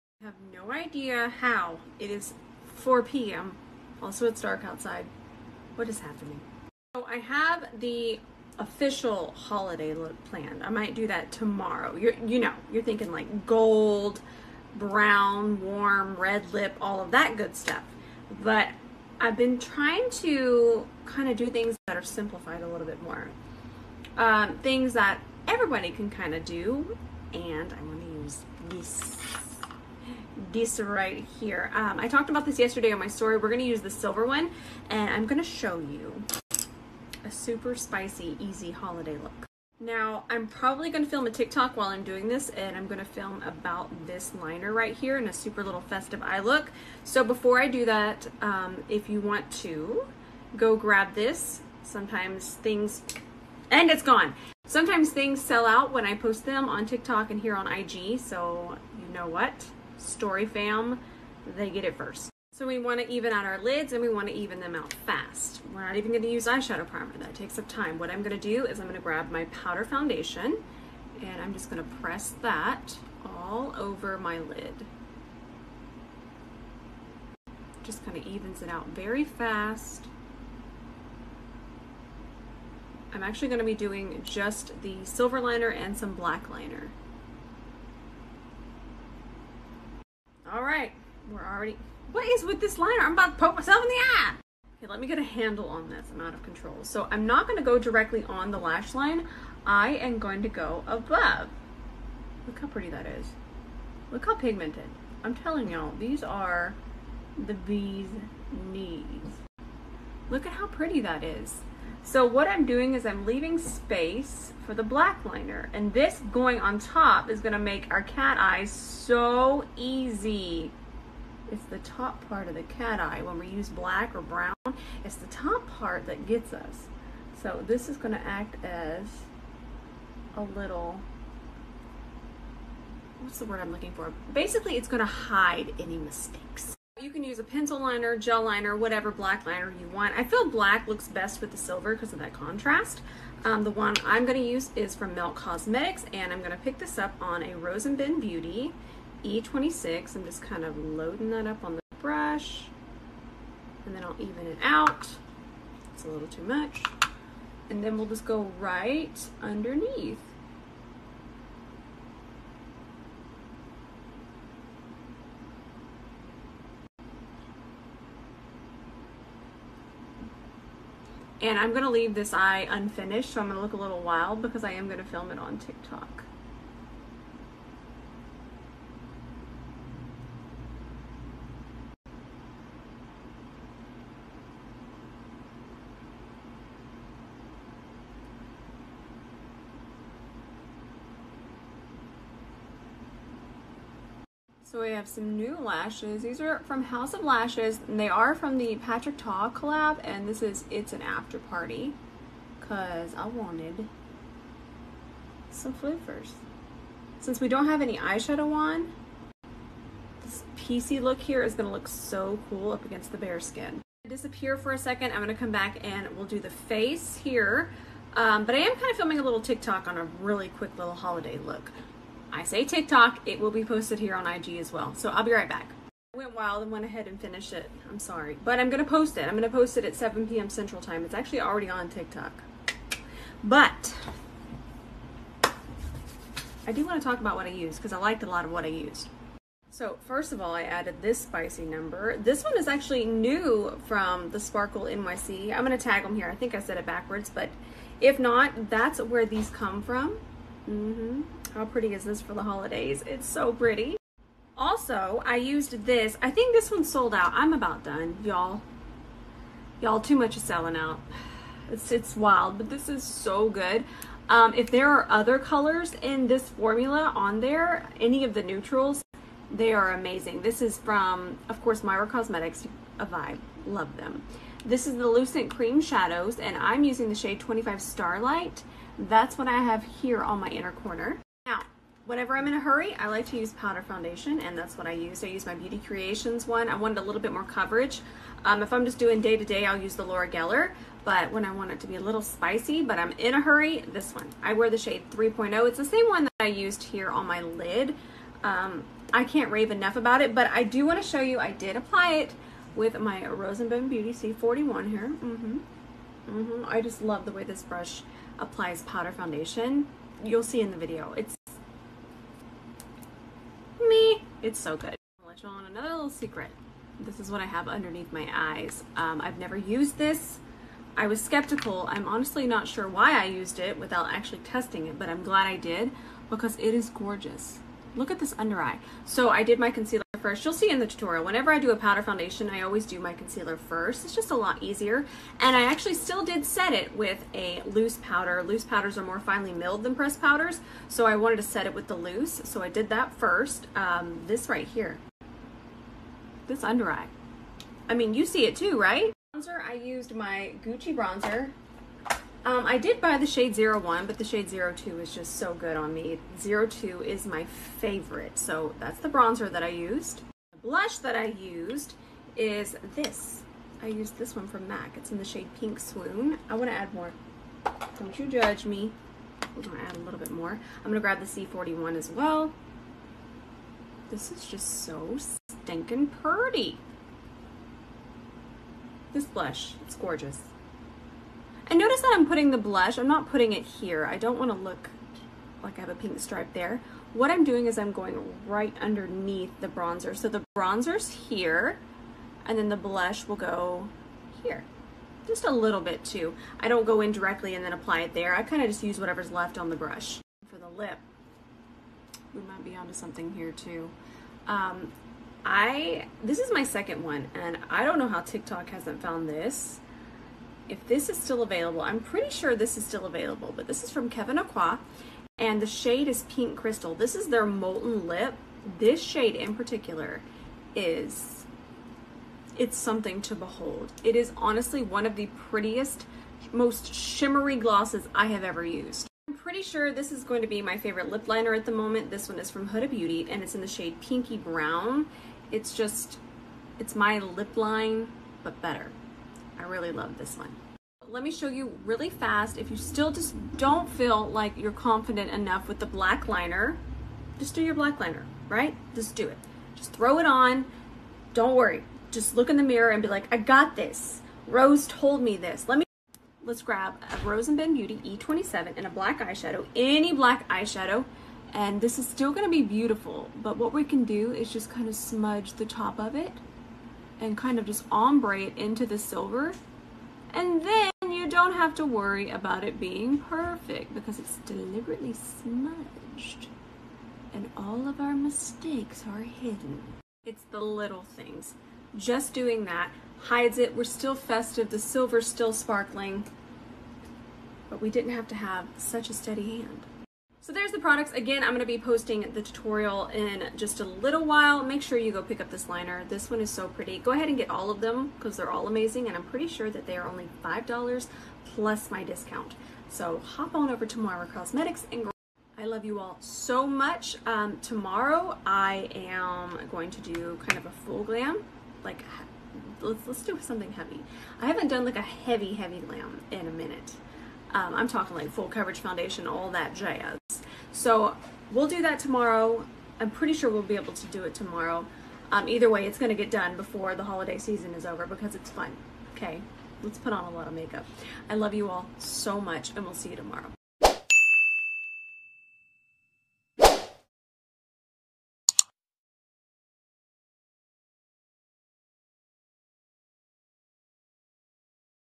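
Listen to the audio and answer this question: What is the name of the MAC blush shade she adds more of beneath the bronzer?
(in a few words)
Pink Swoon.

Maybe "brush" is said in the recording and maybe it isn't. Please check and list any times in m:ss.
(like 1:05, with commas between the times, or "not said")
2:31, 5:07, 6:39.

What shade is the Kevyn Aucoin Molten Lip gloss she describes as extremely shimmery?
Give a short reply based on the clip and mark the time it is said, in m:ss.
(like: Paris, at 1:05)
Pink Crystal, at 6:56.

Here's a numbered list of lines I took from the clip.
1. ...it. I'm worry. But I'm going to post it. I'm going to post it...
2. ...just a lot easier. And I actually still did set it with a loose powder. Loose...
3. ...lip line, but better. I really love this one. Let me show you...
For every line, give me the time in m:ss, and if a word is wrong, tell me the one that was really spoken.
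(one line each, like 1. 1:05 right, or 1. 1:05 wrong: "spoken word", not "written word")
1. 3:47 wrong: "sorry", not "worry"
2. 5:34 right
3. 7:17 right.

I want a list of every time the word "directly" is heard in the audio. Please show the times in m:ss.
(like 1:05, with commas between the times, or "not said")
1:37, 6:37.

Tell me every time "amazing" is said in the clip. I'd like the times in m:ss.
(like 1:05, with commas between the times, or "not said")
4:29, 8:18.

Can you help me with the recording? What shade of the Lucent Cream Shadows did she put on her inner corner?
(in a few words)
25 Starlight.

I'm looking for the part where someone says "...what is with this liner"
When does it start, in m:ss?
1:32.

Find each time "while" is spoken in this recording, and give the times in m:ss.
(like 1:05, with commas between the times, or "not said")
0:41, 8:14.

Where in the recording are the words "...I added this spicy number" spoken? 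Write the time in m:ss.
4:00.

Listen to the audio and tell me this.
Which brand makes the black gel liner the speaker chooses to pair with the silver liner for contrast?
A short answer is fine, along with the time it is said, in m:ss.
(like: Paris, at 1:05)
Melt Cosmetics, at 2:25.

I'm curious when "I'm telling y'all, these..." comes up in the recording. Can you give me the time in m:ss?
1:45.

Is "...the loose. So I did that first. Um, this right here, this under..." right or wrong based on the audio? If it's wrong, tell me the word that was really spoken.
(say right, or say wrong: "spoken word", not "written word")
right.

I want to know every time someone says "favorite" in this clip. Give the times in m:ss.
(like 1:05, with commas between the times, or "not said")
5:57, 7:10.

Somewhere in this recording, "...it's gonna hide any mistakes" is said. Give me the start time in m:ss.
2:14.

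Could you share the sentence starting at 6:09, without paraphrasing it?
We're going to add a little bit more.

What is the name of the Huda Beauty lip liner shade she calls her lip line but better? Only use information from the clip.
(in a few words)
Pinky Brown.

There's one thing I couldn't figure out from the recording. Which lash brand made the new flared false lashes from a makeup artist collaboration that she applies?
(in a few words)
House of Lashes.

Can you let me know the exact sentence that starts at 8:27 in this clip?
Um, tomorrow I am going to do kind of a full glam, like let's, let's do something heavy.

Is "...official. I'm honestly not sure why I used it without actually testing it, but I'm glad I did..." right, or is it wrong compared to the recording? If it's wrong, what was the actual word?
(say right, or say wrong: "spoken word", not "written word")
wrong: "skeptical", not "official".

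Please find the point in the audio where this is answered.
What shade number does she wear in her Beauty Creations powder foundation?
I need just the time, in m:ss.
4:55.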